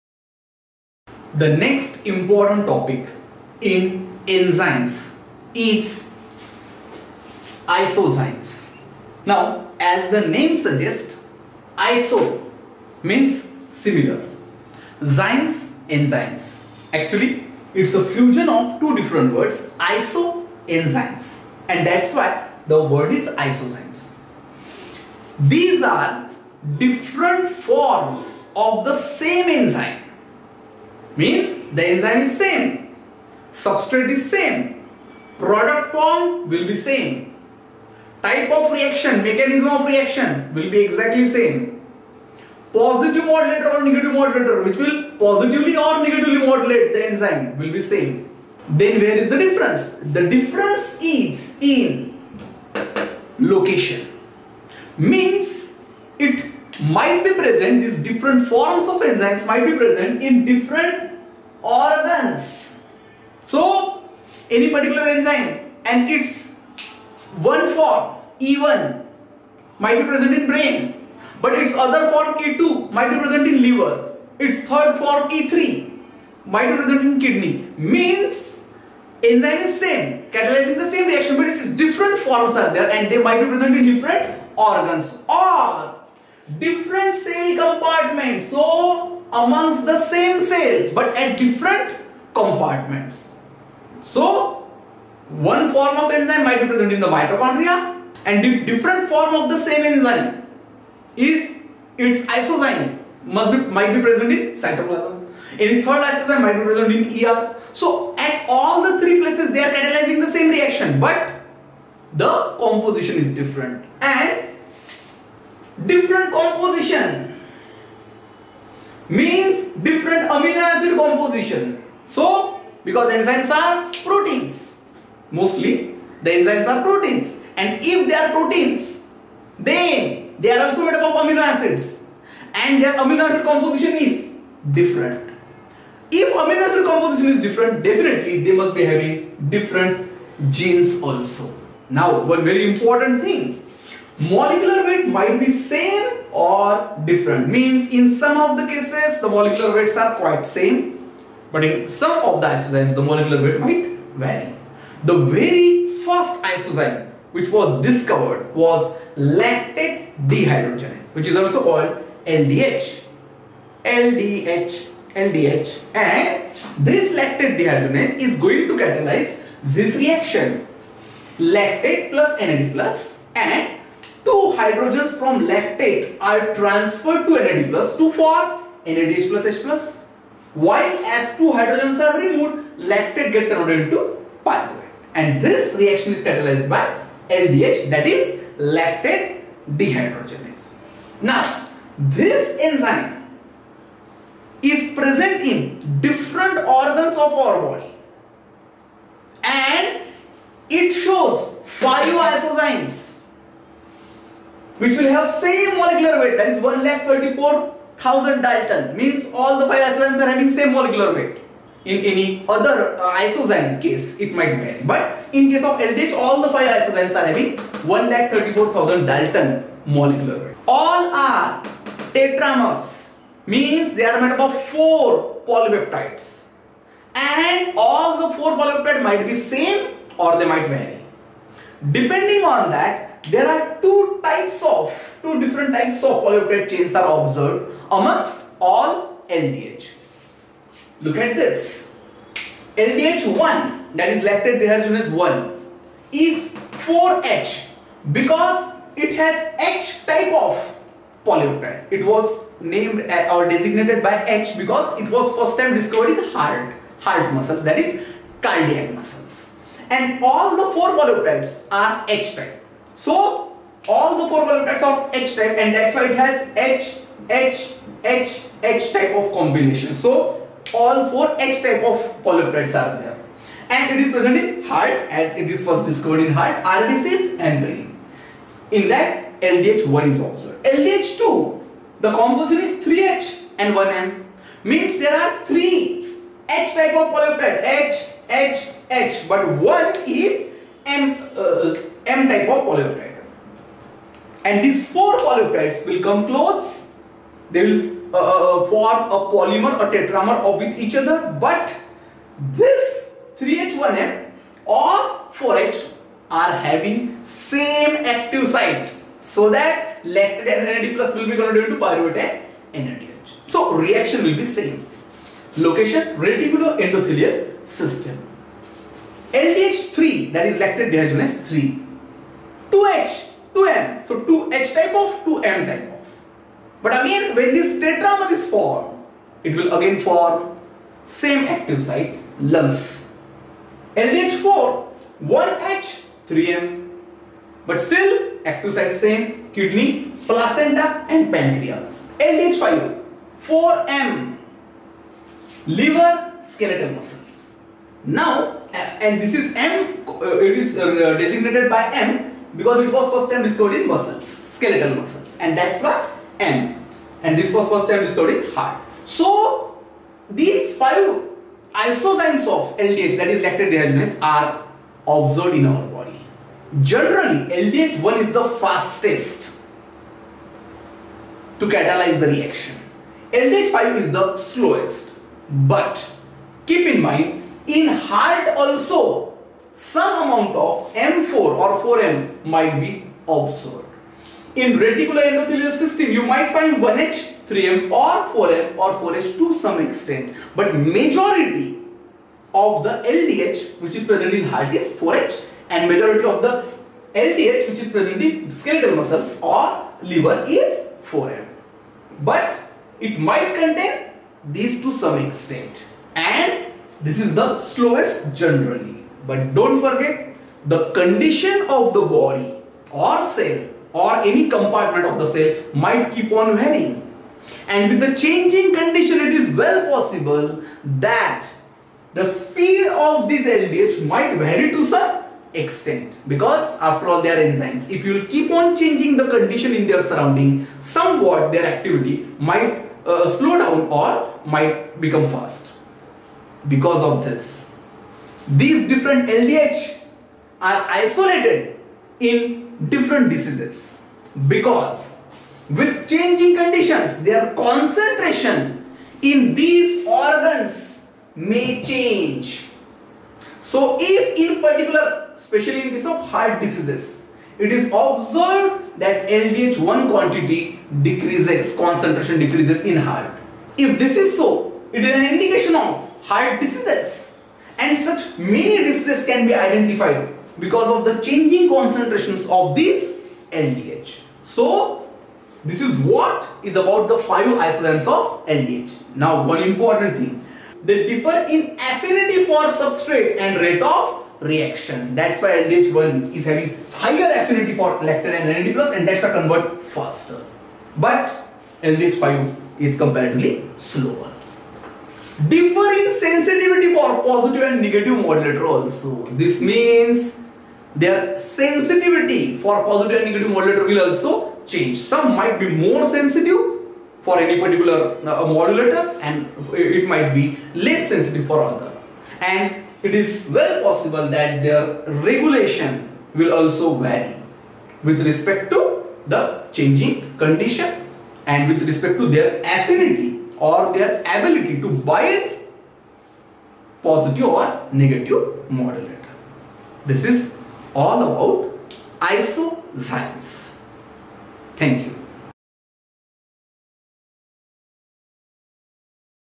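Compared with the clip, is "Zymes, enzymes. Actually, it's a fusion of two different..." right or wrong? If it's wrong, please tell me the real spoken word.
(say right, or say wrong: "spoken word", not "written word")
right.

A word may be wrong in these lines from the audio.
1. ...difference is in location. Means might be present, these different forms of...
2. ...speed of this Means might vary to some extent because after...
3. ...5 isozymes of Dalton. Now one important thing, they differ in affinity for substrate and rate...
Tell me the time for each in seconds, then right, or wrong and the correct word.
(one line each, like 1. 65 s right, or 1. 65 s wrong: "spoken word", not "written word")
1. 50 s right
2. 422 s wrong: "LDH", not "Means"
3. 477 s wrong: "LDH", not "Dalton".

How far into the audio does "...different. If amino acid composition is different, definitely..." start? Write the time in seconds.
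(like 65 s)
134 s.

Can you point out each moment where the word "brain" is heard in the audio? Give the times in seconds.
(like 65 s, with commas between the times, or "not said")
70 s, 277 s.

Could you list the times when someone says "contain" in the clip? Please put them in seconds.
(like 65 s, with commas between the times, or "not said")
403 s.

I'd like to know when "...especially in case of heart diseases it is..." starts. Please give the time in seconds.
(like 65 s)
455 s.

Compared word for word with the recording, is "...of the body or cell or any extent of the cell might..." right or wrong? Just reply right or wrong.
wrong.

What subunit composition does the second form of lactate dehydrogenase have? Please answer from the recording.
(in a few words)
3H and 1M.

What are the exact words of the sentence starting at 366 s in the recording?
Generally, LDH1 is the fastest to catalyze the reaction.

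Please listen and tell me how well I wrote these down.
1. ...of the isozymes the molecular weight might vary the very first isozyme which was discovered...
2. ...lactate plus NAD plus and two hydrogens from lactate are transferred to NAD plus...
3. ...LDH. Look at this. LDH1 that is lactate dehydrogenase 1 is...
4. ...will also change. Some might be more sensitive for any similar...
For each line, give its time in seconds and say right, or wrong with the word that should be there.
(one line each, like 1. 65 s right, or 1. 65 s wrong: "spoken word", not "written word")
1. 152 s right
2. 171 s right
3. 239 s right
4. 503 s wrong: "particular", not "similar".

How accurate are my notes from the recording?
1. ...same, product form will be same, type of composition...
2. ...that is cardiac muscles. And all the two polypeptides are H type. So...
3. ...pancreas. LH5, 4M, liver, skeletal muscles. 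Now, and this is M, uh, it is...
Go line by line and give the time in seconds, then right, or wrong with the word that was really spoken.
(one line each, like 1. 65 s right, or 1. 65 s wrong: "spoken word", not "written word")
1. 34 s wrong: "reaction", not "composition"
2. 257 s wrong: "four", not "two"
3. 341 s right.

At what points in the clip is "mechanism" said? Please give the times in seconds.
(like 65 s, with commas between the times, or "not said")
39 s.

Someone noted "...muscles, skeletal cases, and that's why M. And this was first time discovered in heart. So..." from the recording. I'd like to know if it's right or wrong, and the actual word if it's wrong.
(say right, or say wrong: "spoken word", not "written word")
wrong: "muscles", not "cases".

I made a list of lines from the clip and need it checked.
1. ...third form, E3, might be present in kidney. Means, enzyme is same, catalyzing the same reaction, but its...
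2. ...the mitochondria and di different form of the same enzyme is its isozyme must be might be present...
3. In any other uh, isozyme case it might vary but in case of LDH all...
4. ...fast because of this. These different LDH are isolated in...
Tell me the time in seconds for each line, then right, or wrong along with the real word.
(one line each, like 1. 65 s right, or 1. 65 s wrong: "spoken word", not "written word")
1. 74 s right
2. 96 s right
3. 211 s right
4. 435 s right.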